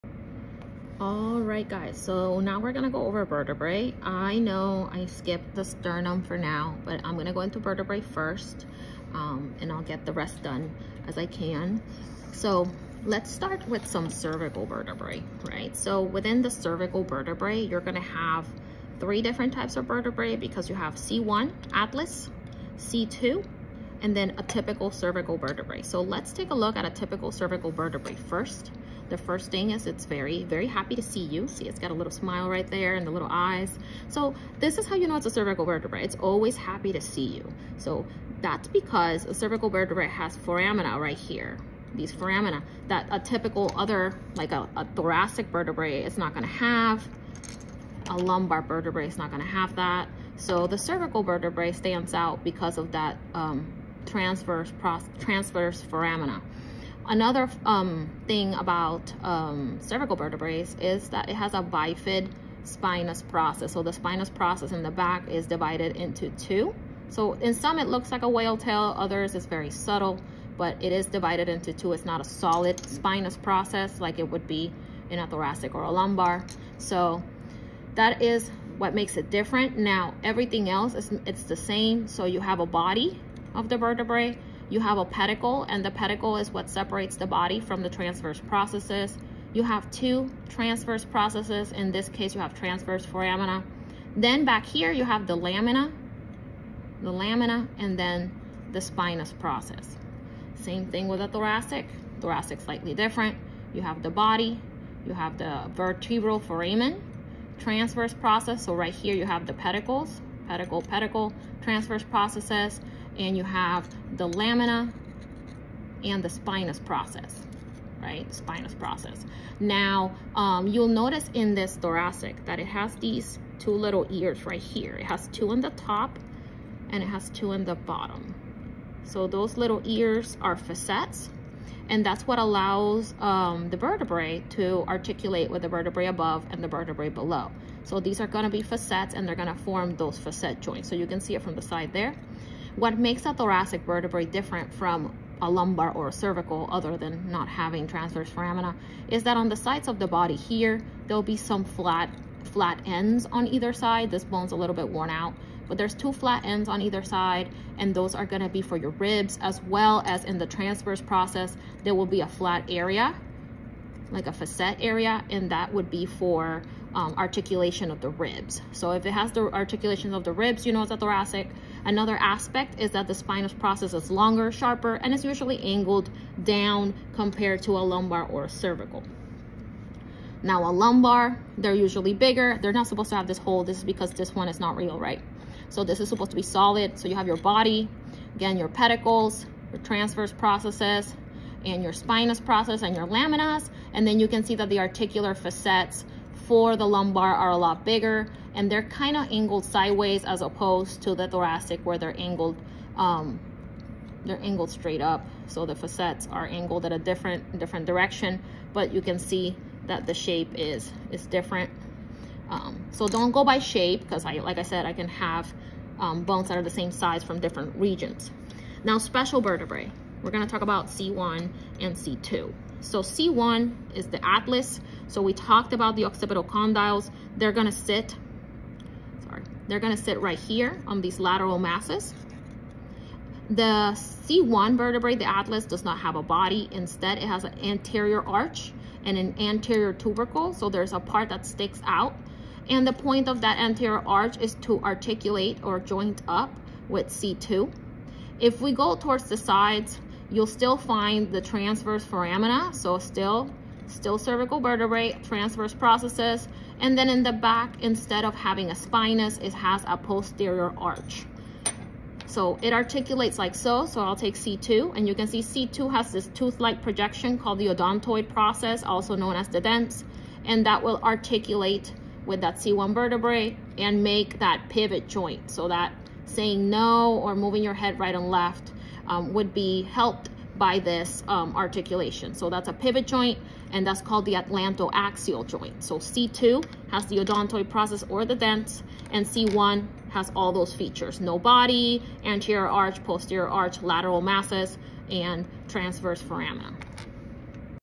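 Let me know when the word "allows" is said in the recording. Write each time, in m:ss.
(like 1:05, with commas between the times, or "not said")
2:12.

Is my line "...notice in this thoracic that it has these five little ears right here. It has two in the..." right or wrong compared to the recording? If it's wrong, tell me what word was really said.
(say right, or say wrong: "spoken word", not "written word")
wrong: "two", not "five".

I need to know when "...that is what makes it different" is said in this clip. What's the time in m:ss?
1:17.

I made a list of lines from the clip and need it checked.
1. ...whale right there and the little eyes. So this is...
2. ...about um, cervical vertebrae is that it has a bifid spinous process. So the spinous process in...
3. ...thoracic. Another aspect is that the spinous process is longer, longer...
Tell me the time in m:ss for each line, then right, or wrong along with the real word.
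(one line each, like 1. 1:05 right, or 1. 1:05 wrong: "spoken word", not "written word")
1. 0:32 wrong: "smile", not "whale"
2. 0:58 right
3. 2:50 wrong: "sharper", not "longer".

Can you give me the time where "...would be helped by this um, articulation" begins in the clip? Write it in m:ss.
4:39.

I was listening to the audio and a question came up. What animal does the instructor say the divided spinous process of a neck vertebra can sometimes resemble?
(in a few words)
whale tail.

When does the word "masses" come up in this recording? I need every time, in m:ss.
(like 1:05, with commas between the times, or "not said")
3:51, 4:54.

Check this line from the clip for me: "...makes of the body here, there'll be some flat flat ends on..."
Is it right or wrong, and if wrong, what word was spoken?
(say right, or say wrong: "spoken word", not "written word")
wrong: "sides", not "makes".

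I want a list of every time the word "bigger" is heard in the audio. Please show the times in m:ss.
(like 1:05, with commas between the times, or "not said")
3:02, 3:17.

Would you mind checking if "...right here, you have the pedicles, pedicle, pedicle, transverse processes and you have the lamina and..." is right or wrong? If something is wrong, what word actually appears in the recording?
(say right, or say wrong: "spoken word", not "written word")
right.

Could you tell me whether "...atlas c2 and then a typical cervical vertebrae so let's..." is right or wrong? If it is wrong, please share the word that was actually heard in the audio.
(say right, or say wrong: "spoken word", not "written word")
right.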